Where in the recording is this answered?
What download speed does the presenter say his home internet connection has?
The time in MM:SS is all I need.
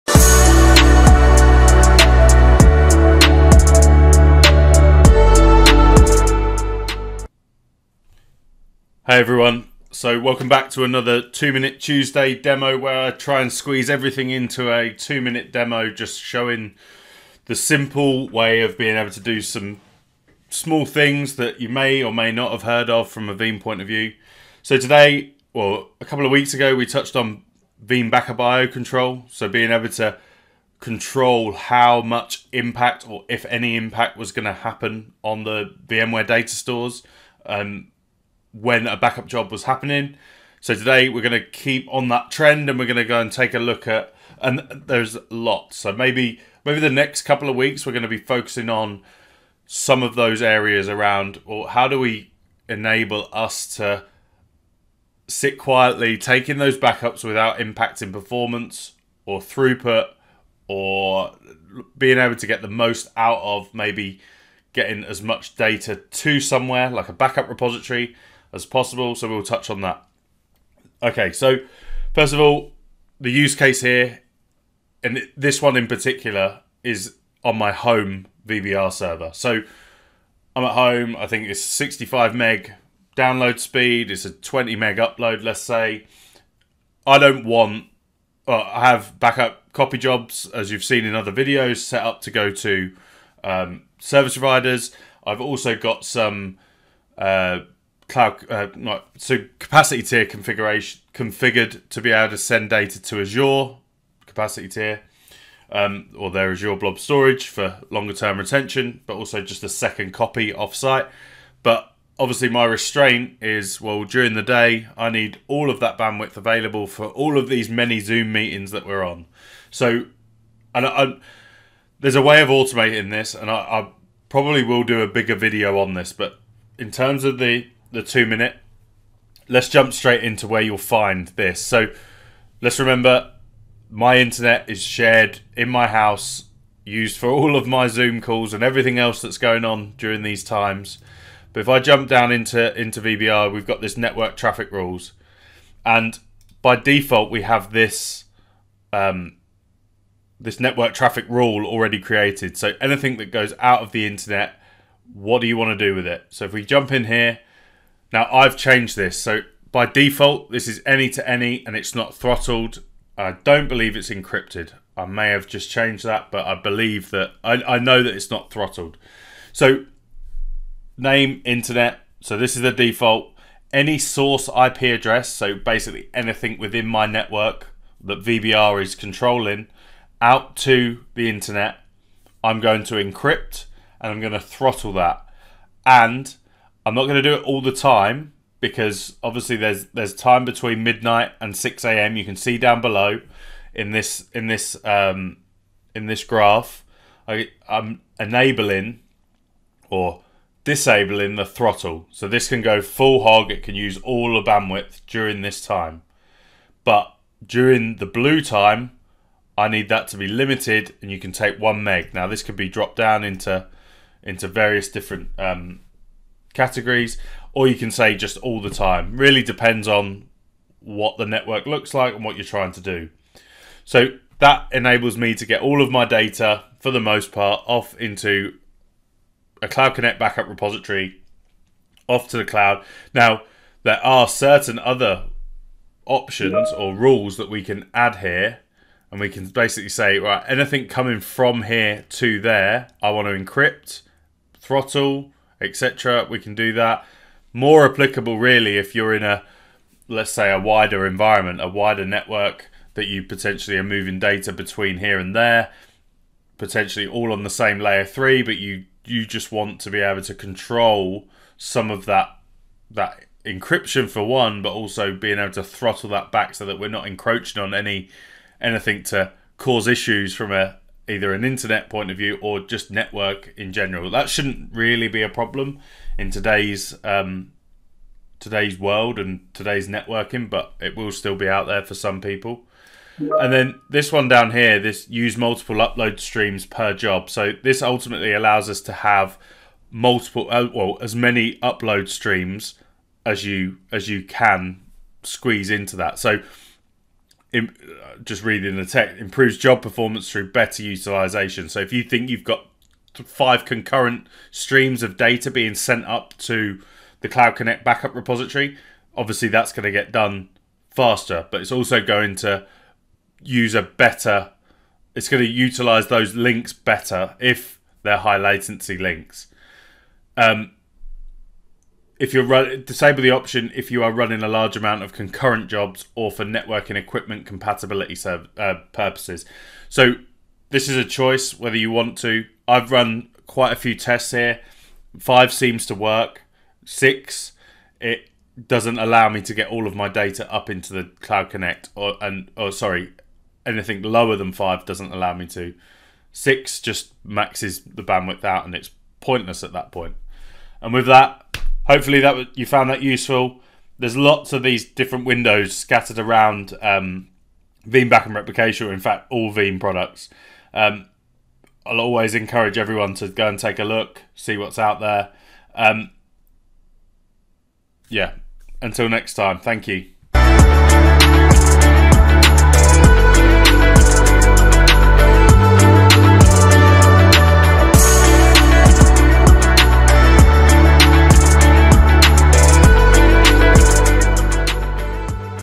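01:21.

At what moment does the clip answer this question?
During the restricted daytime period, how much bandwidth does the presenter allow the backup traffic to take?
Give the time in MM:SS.
03:31.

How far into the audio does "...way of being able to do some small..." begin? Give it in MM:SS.
00:18.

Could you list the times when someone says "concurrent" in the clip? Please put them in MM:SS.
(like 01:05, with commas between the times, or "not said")
05:03, 05:25.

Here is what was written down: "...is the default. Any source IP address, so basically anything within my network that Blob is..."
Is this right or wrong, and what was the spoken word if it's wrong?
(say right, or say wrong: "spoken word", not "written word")
wrong: "VBR", not "Blob".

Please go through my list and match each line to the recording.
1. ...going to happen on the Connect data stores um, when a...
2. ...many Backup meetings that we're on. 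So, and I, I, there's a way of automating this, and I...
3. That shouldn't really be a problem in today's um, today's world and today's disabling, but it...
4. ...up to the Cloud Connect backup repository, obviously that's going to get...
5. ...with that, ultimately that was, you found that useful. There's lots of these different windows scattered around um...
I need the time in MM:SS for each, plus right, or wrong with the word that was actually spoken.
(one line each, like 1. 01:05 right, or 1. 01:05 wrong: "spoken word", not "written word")
1. 00:34 wrong: "VMware", not "Connect"
2. 01:57 wrong: "Zoom", not "Backup"
3. 04:34 wrong: "networking", not "disabling"
4. 05:06 right
5. 05:50 wrong: "hopefully", not "ultimately".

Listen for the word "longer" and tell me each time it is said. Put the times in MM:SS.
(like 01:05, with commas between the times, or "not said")
01:47.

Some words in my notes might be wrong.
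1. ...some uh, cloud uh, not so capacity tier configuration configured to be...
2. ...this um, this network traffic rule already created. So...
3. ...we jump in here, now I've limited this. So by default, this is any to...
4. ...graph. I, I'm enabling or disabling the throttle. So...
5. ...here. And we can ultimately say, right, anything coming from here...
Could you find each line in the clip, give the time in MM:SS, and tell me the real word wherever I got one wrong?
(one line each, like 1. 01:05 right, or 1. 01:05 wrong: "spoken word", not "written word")
1. 01:36 right
2. 02:27 right
3. 02:36 wrong: "changed", not "limited"
4. 03:16 right
5. 03:58 wrong: "basically", not "ultimately".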